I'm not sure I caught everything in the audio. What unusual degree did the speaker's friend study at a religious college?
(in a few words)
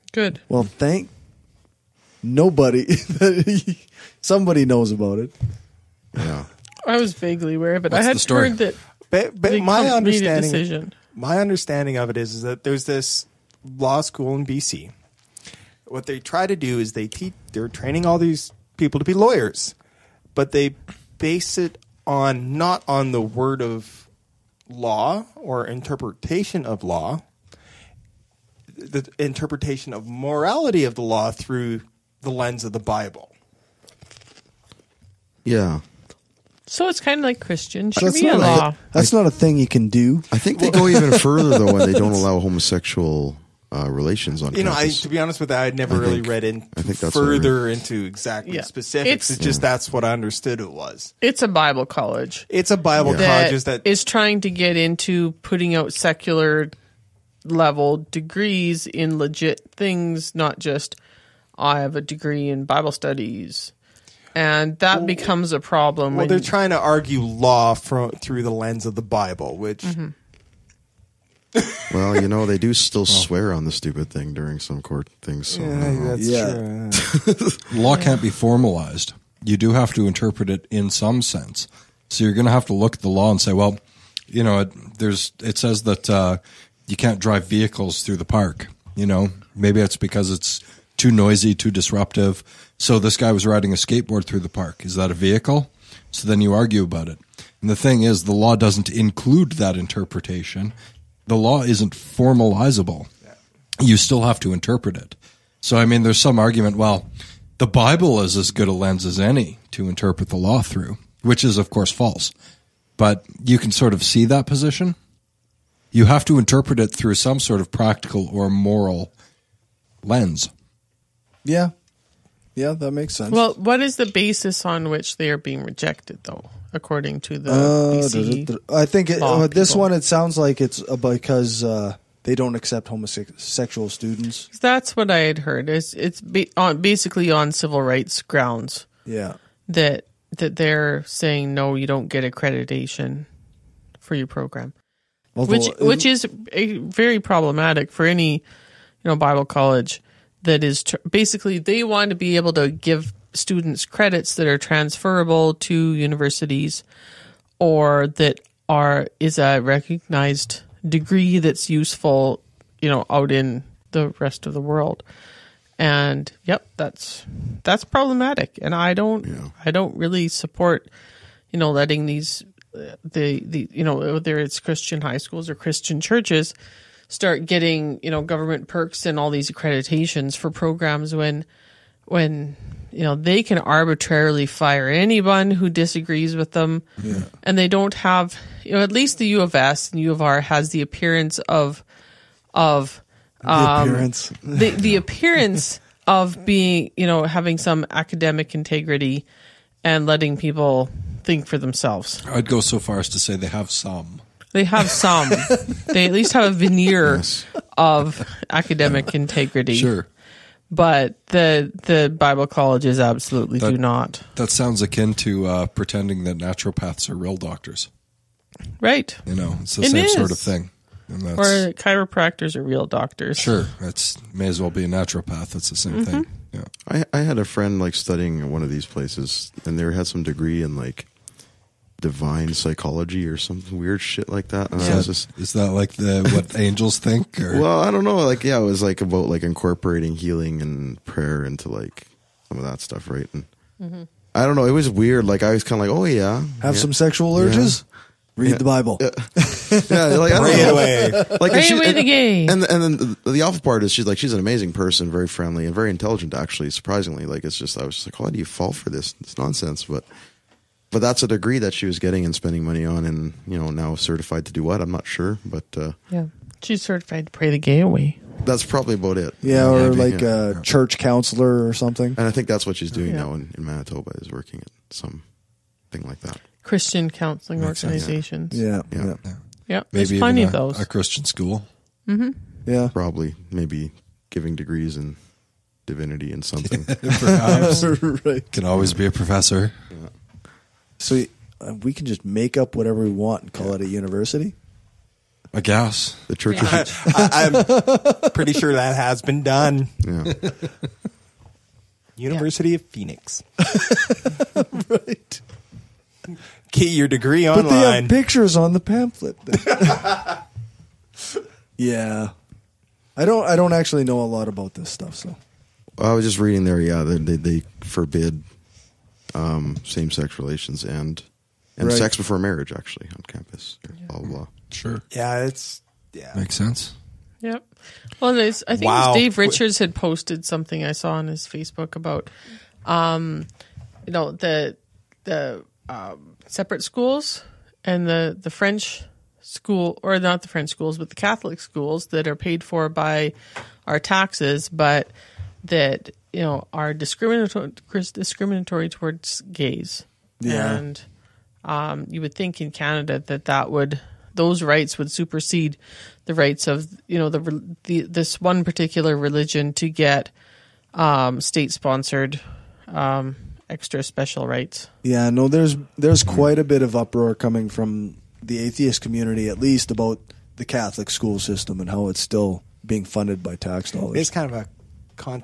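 divine psychology.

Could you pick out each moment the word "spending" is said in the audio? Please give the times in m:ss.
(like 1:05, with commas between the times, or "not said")
4:22.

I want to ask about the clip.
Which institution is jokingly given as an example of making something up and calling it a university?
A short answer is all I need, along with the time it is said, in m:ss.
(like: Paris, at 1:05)
University of Phoenix, at 5:02.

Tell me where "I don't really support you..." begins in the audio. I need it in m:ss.
2:49.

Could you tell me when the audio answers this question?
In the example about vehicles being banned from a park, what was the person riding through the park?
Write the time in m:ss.
1:33.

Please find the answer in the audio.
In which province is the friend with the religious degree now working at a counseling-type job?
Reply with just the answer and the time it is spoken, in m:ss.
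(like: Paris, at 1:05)
Manitoba, at 4:33.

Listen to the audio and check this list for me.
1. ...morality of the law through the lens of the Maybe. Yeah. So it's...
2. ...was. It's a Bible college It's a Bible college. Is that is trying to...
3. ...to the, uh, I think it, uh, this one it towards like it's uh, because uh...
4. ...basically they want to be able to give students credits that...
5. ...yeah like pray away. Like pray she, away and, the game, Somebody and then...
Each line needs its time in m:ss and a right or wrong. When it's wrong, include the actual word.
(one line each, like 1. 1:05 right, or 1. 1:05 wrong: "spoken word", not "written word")
1. 0:30 wrong: "Bible", not "Maybe"
2. 0:50 right
3. 2:07 wrong: "sounds", not "towards"
4. 2:31 right
5. 4:09 wrong: "And", not "Somebody".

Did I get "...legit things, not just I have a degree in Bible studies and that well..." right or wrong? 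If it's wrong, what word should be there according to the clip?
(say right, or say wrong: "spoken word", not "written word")
right.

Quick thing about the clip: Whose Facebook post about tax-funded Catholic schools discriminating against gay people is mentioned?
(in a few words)
Dave Richards.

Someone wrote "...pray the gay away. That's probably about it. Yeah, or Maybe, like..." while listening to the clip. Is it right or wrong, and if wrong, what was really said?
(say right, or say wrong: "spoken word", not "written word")
right.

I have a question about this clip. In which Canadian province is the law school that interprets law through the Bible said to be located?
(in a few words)
BC.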